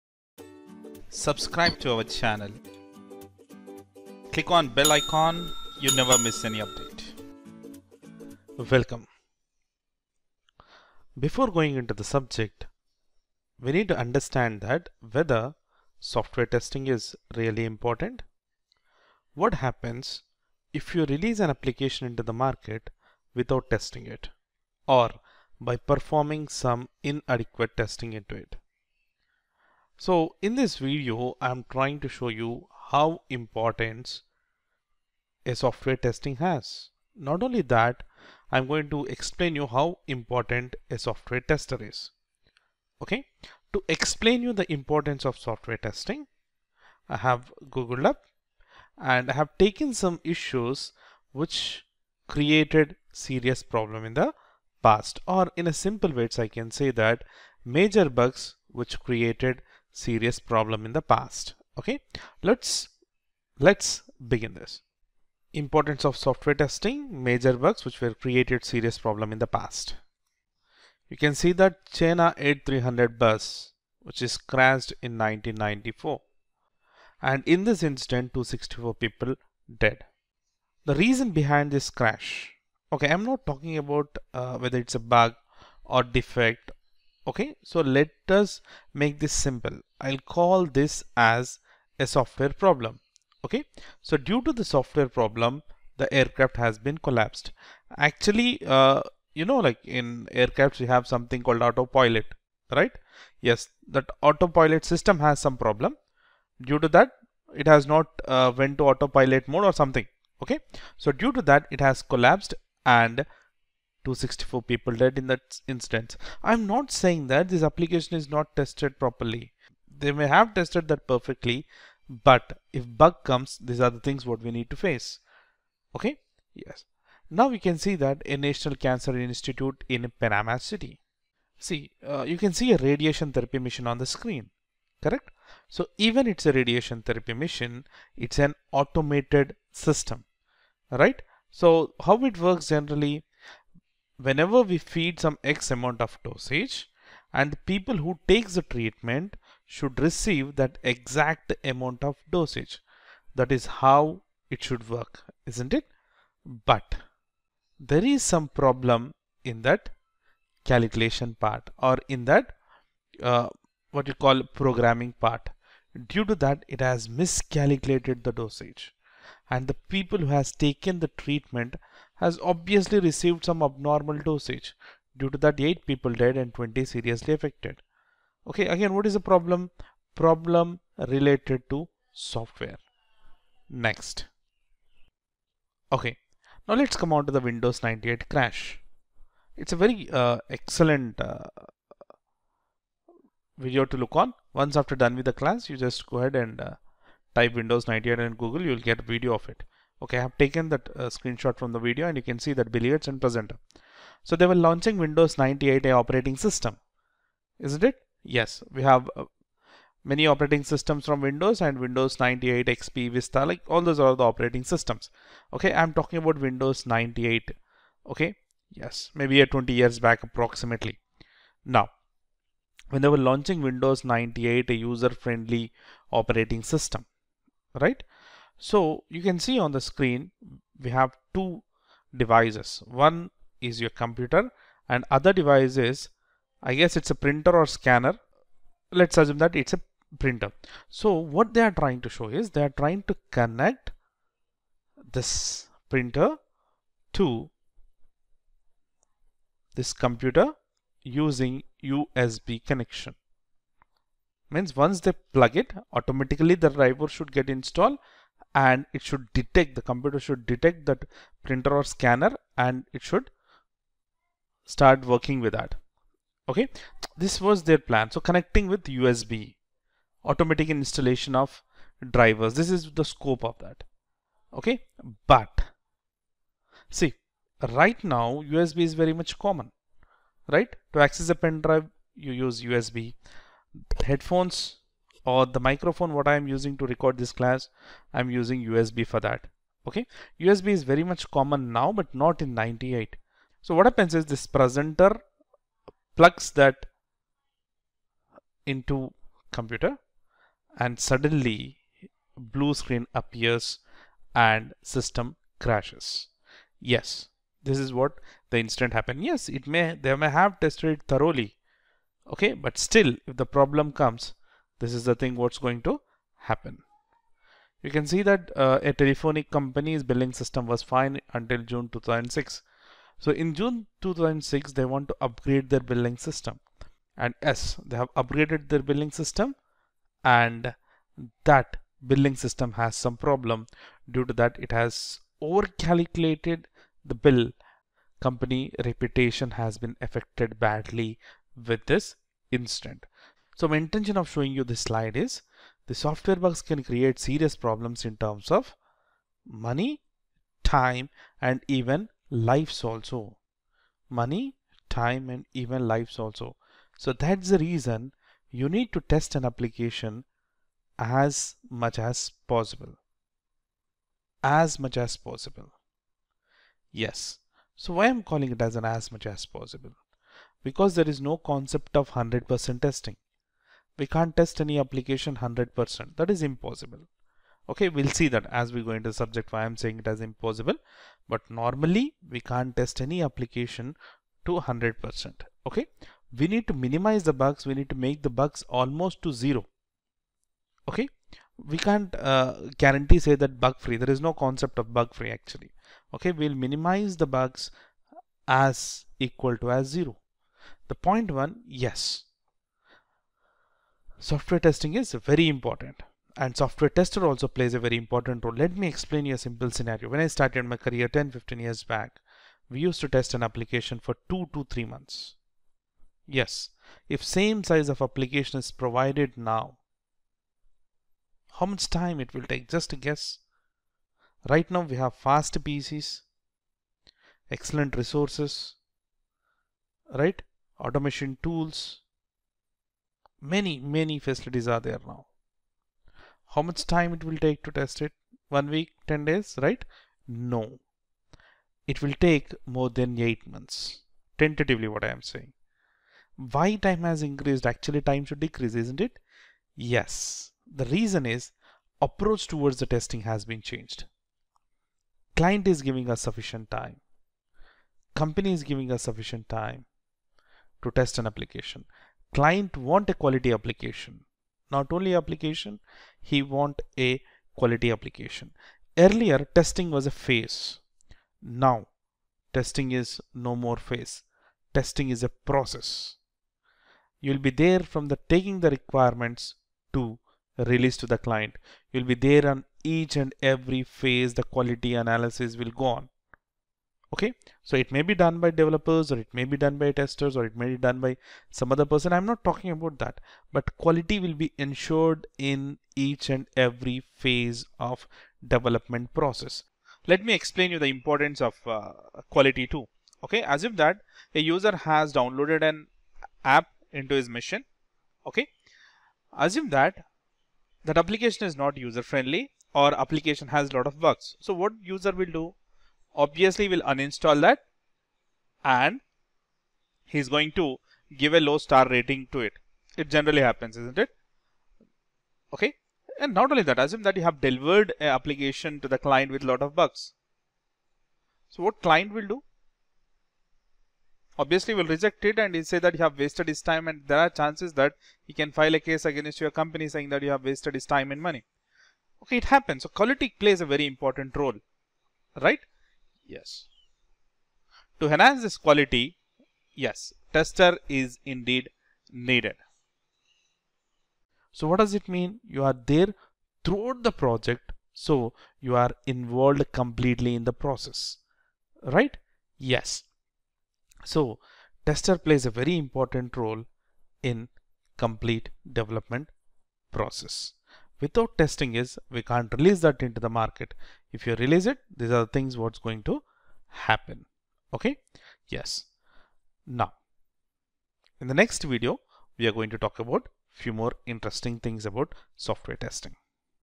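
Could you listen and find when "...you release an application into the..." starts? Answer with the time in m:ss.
0:20.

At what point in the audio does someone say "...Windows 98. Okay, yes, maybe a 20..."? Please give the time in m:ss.
3:36.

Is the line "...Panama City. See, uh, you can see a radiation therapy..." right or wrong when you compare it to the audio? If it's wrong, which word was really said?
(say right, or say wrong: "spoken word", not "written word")
right.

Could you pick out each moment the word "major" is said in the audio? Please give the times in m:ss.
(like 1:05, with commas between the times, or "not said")
0:57, 1:07.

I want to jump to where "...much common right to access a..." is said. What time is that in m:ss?
4:39.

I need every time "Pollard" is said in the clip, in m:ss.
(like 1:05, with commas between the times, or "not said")
not said.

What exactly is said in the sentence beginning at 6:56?
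Yes, if same size of application is provided now, how much time it will take?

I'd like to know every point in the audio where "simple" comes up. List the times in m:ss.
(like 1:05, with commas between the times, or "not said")
0:55, 1:29, 6:49.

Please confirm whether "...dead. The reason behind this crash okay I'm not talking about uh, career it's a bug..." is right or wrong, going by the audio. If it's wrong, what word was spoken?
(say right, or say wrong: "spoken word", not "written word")
wrong: "whether", not "career".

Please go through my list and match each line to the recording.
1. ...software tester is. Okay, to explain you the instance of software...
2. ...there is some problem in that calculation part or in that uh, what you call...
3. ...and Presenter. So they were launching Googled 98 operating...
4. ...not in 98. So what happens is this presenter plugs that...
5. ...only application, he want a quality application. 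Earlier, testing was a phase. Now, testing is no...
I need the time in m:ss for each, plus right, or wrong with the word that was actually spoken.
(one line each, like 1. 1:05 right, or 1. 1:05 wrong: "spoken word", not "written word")
1. 0:40 wrong: "importance", not "instance"
2. 2:37 right
3. 3:23 wrong: "Windows", not "Googled"
4. 4:52 right
5. 7:44 right.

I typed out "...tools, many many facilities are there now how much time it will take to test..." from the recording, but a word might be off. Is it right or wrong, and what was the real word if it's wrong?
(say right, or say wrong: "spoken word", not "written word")
right.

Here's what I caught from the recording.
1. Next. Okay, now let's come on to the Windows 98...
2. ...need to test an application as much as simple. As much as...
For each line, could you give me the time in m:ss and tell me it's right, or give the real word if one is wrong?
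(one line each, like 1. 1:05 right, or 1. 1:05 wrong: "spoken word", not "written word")
1. 3:03 right
2. 5:58 wrong: "possible", not "simple".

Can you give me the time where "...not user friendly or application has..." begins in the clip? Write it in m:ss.
8:31.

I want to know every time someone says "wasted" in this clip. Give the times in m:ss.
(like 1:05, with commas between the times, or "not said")
8:56, 9:00.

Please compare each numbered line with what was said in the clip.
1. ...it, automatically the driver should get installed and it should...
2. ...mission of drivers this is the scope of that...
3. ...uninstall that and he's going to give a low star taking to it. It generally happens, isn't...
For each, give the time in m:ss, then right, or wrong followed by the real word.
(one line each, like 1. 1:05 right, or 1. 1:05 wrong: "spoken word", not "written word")
1. 4:15 right
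2. 4:30 wrong: "installation", not "mission"
3. 8:36 wrong: "rating", not "taking".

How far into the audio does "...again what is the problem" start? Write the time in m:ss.
2:58.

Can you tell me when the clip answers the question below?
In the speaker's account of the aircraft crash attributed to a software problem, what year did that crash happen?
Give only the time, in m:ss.
1:15.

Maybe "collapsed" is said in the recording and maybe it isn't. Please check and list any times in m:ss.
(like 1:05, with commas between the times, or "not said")
1:36, 1:52.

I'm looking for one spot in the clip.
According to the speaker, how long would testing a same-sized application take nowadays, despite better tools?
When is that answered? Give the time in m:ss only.
7:22.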